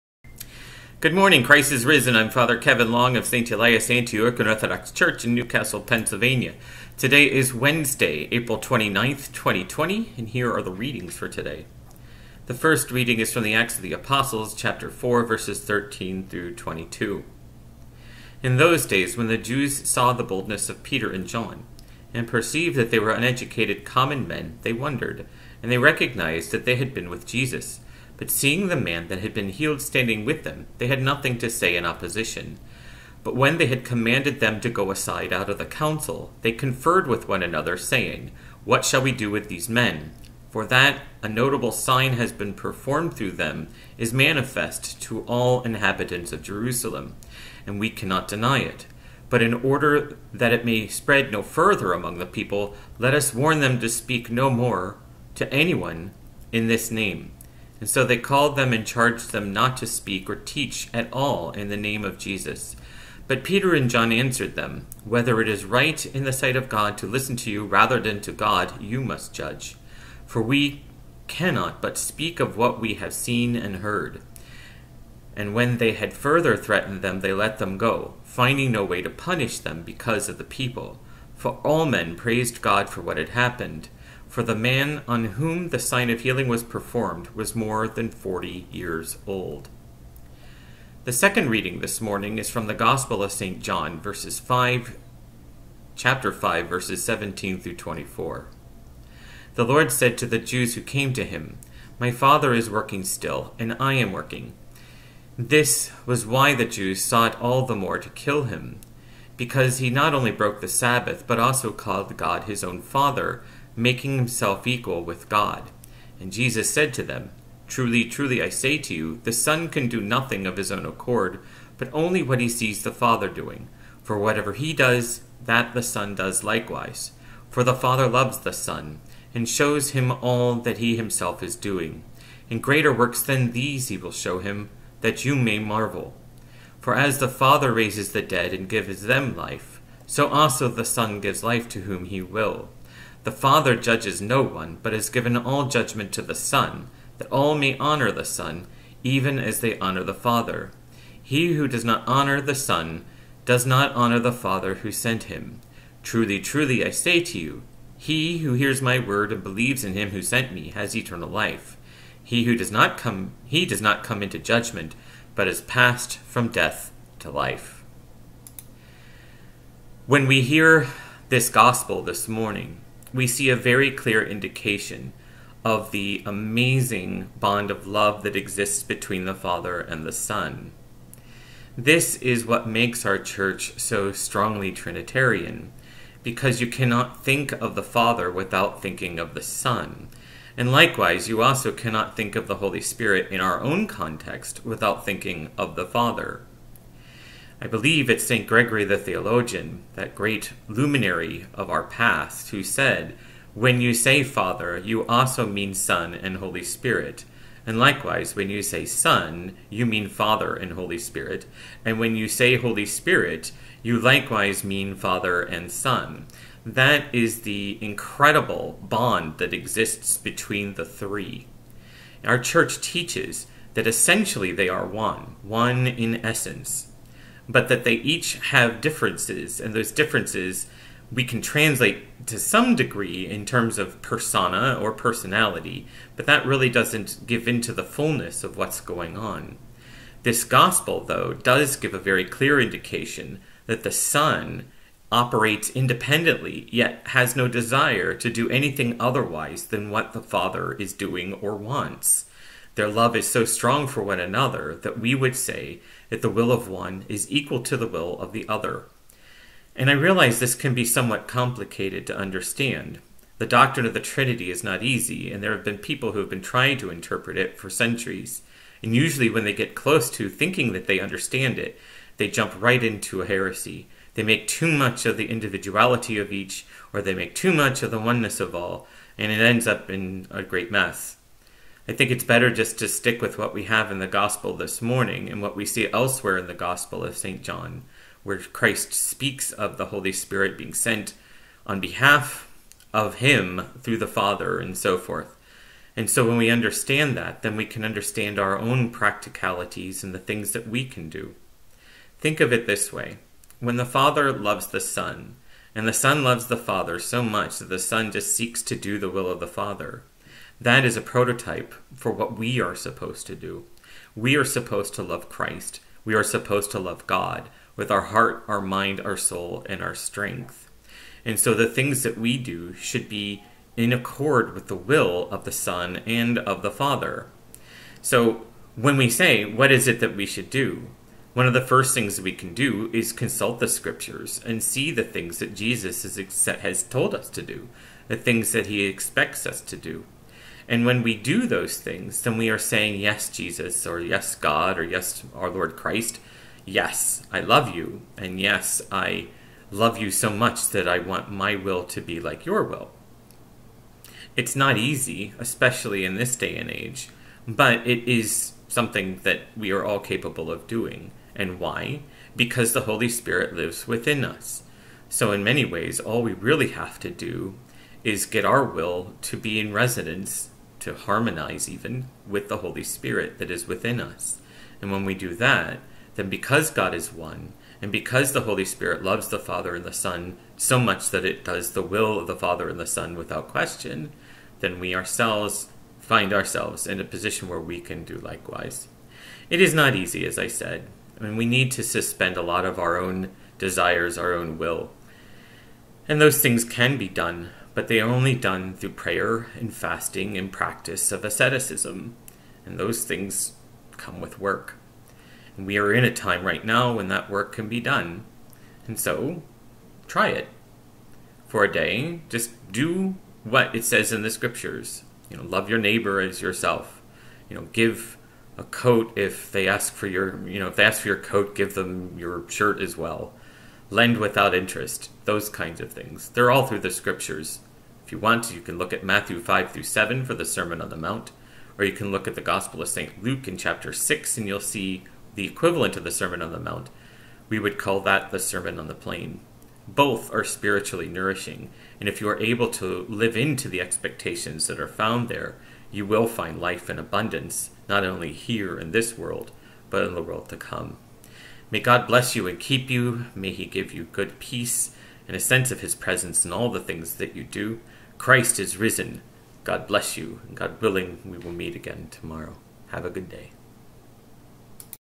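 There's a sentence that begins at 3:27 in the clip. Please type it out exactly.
And likewise, when you say Son, you mean Father and Holy Spirit.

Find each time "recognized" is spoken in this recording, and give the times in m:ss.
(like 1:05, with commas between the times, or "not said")
0:25.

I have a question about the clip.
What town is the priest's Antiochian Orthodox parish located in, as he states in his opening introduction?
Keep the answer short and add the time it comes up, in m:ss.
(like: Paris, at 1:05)
Newcastle, Pennsylvania, at 0:05.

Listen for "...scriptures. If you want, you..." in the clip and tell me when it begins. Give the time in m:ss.
7:06.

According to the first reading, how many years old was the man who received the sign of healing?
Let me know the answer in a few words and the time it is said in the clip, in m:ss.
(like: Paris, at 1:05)
more than 40, at 1:27.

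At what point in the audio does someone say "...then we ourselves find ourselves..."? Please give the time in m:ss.
6:24.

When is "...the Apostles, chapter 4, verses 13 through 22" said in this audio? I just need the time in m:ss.
0:13.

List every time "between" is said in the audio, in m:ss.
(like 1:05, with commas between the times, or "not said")
2:58, 3:40.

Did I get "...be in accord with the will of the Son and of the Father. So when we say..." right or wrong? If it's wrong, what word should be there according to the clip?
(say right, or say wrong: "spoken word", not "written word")
right.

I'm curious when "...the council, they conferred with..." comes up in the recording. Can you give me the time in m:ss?
0:35.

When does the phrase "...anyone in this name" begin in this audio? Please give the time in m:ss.
0:55.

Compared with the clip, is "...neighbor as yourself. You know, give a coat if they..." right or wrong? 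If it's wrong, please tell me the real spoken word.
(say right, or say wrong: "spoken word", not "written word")
right.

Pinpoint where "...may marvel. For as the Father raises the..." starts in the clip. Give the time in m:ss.
2:15.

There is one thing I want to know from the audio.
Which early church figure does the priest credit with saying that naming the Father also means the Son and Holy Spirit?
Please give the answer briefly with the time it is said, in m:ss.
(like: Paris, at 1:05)
St. Gregory the Theologian, at 3:18.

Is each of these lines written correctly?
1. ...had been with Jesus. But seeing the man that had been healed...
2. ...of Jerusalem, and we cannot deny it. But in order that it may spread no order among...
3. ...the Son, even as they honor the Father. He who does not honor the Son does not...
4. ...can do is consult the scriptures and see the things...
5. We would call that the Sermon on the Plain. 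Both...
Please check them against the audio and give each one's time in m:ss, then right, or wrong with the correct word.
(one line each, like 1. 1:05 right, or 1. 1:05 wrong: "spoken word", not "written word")
1. 0:26 right
2. 0:46 wrong: "further", not "order"
3. 2:28 right
4. 5:32 right
5. 7:17 right.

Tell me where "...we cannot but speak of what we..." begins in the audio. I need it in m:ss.
1:10.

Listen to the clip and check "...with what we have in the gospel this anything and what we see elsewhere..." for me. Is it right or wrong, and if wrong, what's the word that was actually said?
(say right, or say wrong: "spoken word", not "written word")
wrong: "morning", not "anything".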